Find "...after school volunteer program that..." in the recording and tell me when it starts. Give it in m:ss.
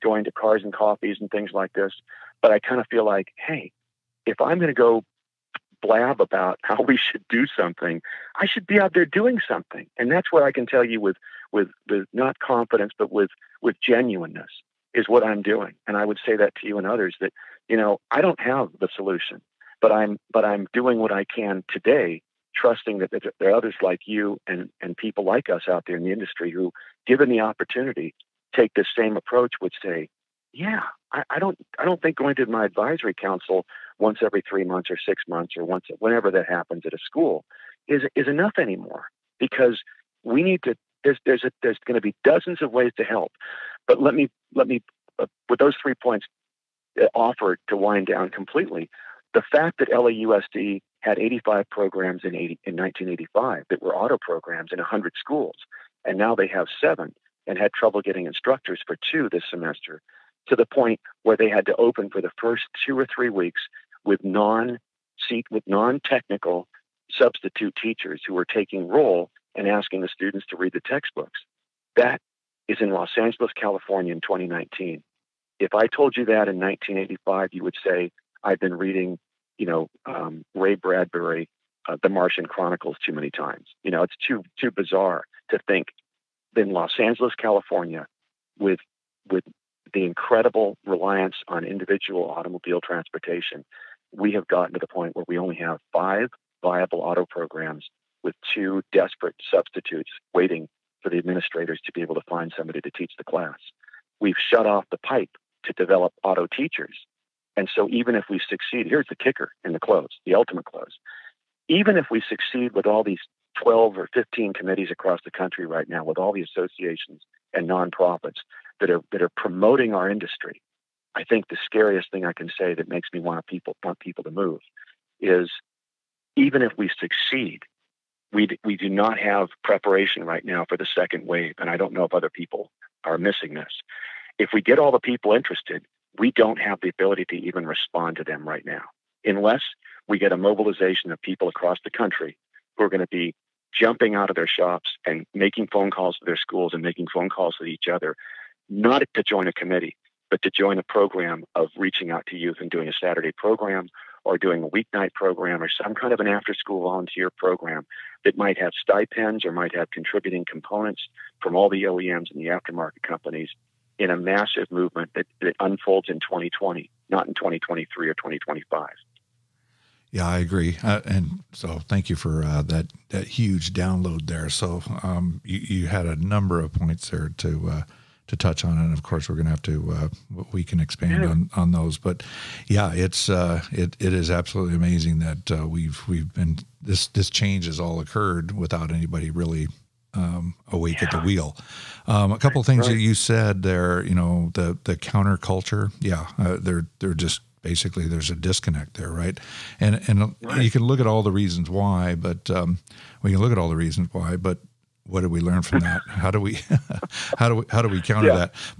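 2:36.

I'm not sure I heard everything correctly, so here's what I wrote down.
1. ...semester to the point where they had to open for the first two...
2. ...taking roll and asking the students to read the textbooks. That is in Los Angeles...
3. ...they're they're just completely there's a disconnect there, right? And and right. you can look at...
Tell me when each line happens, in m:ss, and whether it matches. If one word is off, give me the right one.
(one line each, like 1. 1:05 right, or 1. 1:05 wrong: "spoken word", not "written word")
1. 0:59 right
2. 1:08 right
3. 3:16 wrong: "basically", not "completely".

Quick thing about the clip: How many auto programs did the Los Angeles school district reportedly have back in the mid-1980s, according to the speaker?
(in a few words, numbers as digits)
85.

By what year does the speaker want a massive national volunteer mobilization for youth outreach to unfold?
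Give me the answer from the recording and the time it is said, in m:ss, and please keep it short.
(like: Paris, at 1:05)
2020, at 2:46.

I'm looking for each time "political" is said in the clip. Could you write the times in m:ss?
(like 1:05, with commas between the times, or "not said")
not said.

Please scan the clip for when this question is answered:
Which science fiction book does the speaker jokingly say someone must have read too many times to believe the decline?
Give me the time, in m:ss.
1:22.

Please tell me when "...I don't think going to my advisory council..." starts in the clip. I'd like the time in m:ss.
0:31.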